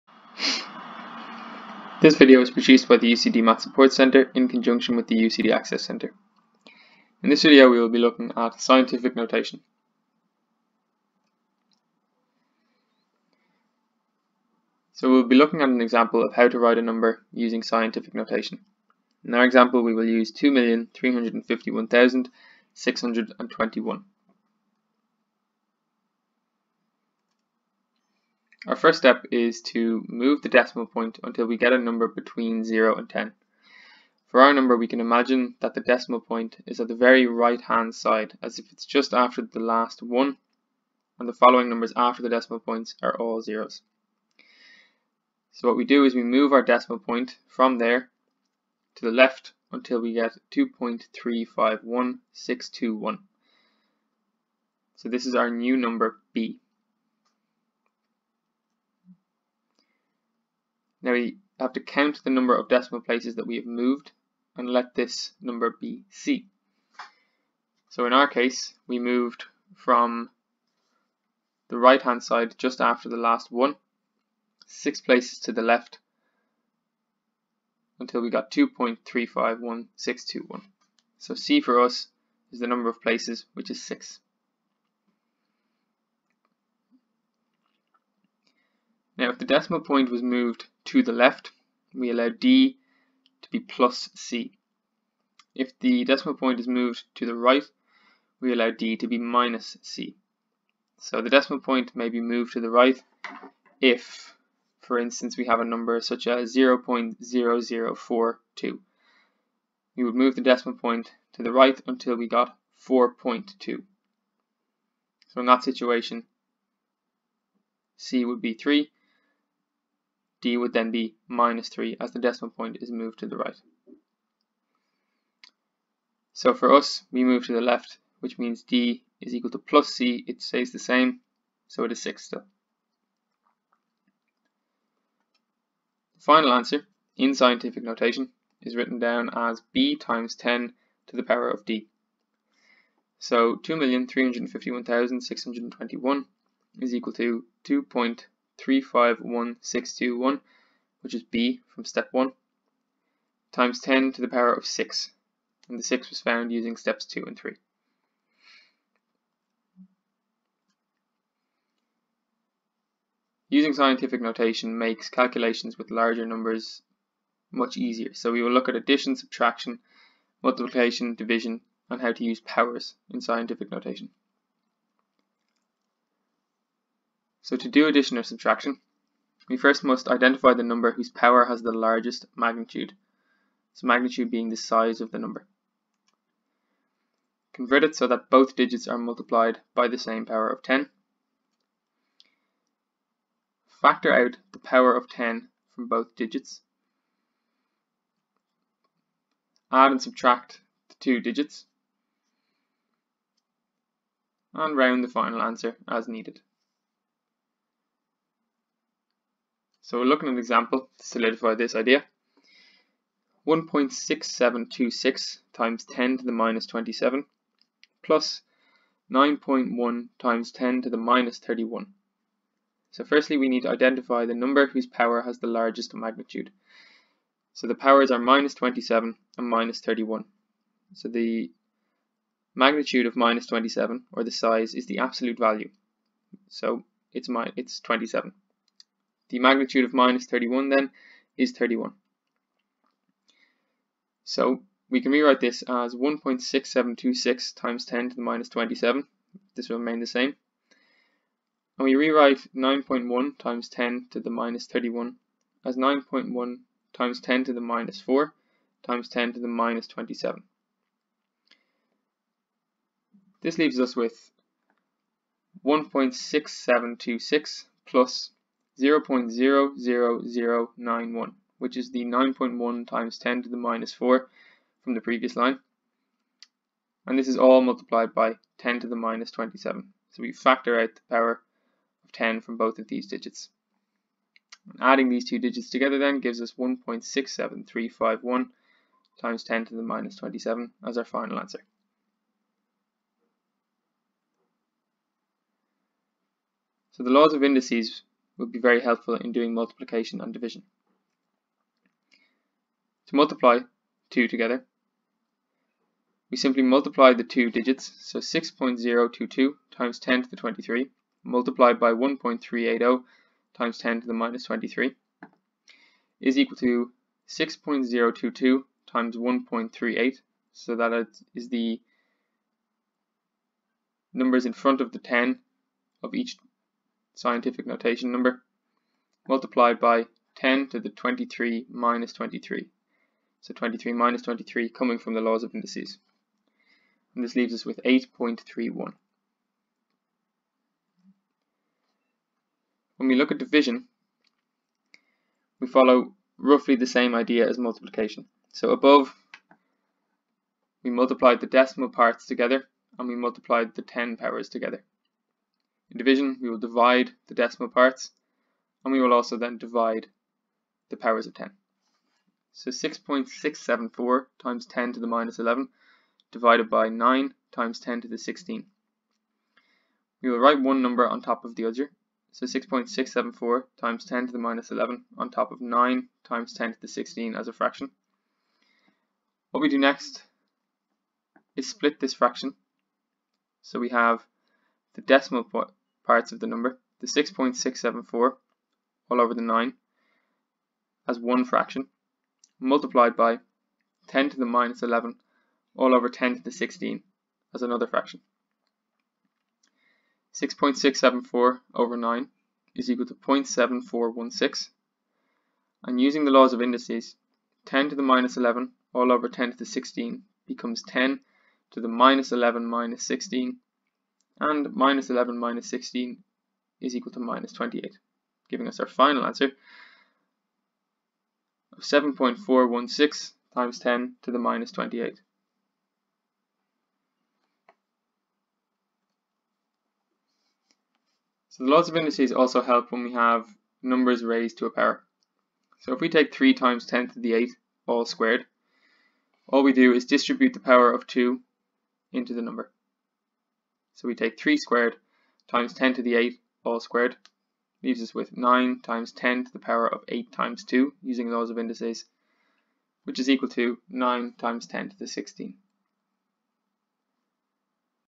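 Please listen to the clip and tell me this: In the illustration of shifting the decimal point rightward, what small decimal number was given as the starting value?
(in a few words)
0.0042.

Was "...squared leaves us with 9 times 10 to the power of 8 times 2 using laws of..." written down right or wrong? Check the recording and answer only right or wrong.
right.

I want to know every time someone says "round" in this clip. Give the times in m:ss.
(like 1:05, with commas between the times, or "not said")
3:24.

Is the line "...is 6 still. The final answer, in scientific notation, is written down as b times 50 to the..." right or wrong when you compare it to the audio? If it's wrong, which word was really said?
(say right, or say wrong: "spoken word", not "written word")
wrong: "10", not "50".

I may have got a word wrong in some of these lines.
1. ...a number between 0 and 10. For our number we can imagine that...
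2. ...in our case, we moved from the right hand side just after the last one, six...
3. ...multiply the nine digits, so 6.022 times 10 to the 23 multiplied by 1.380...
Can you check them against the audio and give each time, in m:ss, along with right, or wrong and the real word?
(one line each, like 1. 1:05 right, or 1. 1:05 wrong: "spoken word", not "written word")
1. 0:31 right
2. 1:08 right
3. 5:06 wrong: "two", not "nine".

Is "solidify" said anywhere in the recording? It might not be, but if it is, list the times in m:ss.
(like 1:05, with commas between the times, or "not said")
3:31.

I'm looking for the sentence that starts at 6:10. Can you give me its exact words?
We will write one number on top of the other.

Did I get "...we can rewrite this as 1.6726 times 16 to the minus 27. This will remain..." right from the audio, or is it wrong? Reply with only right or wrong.
wrong.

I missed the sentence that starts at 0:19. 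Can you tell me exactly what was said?
In our example we will use 2,351,621.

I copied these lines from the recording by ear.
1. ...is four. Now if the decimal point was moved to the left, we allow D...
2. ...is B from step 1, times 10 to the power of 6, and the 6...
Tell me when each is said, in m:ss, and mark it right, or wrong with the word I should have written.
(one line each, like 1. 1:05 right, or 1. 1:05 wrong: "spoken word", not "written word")
1. 1:23 wrong: "six", not "four"
2. 2:31 right.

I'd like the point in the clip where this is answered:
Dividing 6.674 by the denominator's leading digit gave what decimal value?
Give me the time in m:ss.
6:43.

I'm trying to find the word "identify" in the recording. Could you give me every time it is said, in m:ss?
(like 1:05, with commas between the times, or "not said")
3:00, 3:43.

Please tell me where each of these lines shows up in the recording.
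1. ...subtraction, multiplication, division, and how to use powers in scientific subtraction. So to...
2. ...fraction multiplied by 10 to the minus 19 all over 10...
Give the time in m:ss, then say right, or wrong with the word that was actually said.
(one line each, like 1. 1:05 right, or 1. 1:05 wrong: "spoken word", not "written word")
1. 2:49 wrong: "notation", not "subtraction"
2. 6:31 wrong: "11", not "19".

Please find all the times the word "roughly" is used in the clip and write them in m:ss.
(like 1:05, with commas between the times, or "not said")
5:46.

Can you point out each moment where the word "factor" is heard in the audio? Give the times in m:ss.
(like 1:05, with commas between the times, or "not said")
3:13, 4:40.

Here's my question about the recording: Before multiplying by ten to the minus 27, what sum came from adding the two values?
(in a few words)
1.67351.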